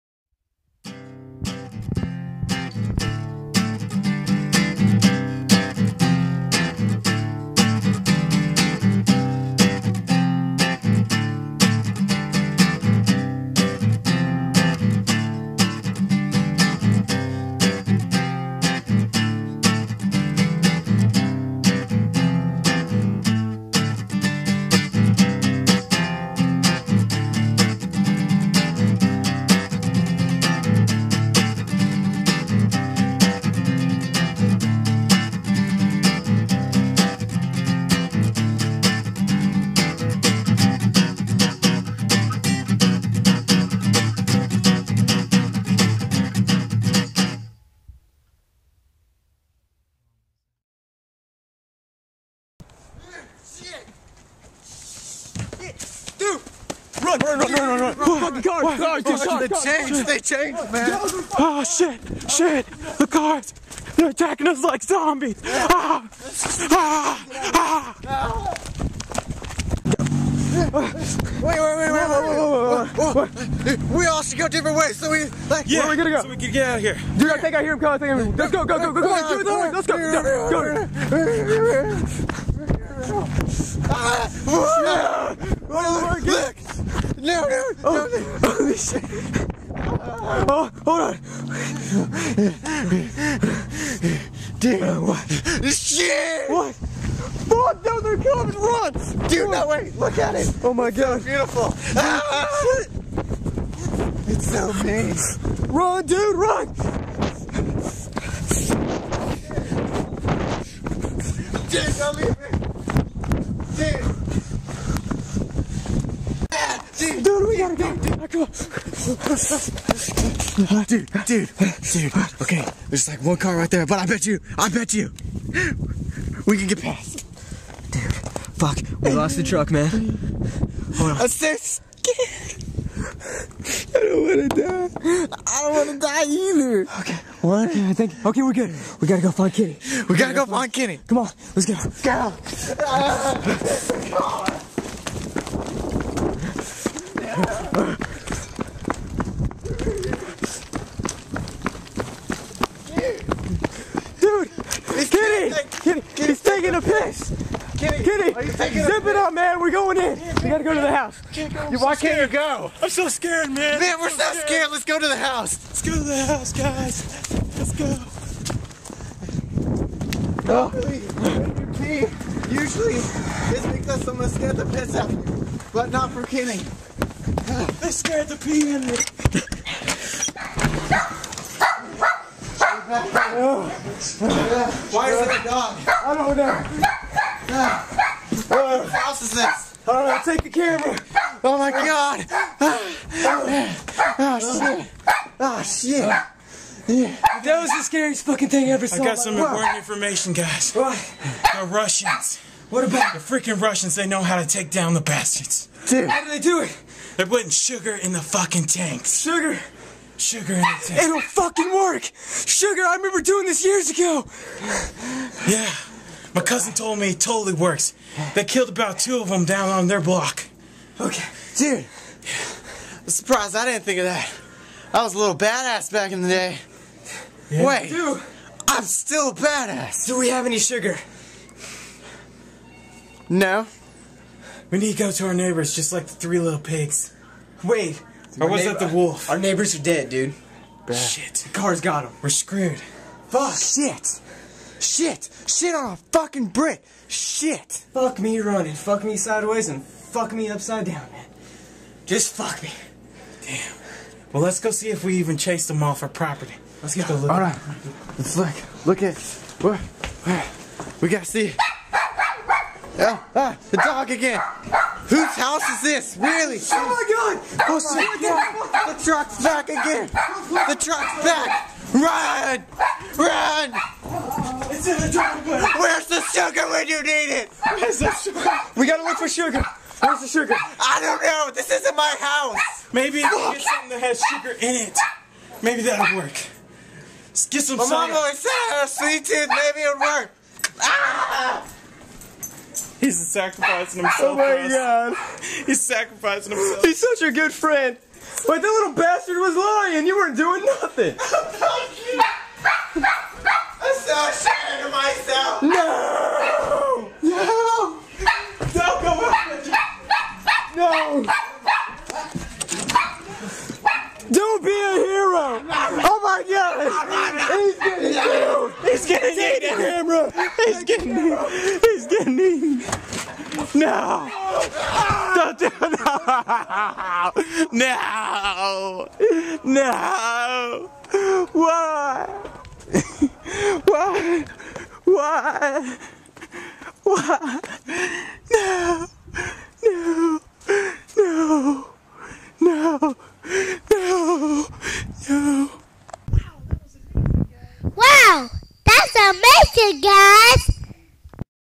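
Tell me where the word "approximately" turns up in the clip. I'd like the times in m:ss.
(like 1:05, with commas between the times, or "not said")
not said.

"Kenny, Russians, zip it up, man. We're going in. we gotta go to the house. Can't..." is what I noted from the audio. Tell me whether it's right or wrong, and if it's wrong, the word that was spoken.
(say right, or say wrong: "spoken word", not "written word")
wrong: "Kenny", not "Russians".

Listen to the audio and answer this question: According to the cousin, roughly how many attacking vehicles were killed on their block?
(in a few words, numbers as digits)
2.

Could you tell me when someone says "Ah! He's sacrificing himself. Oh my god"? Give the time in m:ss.
4:50.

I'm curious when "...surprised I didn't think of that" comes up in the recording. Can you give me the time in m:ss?
3:43.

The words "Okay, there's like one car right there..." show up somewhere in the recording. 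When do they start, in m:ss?
2:02.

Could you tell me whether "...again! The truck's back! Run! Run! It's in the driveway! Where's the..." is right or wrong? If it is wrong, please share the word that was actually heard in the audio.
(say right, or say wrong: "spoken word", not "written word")
right.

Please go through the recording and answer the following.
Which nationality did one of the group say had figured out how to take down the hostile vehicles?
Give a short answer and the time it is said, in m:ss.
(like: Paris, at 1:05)
The Russians, at 3:21.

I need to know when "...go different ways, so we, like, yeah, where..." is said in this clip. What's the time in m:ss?
1:14.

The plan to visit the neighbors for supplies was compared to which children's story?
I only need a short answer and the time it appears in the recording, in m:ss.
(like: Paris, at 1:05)
The three little pigs, at 3:56.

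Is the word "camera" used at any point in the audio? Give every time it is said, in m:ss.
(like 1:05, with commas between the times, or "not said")
3:10, 5:19.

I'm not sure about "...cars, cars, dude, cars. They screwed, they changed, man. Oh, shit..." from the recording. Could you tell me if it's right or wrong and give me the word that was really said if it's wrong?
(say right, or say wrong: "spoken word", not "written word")
wrong: "changed", not "screwed".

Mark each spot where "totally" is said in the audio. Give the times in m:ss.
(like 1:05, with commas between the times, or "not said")
3:37.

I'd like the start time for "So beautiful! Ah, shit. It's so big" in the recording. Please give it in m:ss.
1:41.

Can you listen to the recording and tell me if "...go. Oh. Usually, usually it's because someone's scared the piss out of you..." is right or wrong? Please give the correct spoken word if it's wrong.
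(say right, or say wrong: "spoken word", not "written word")
right.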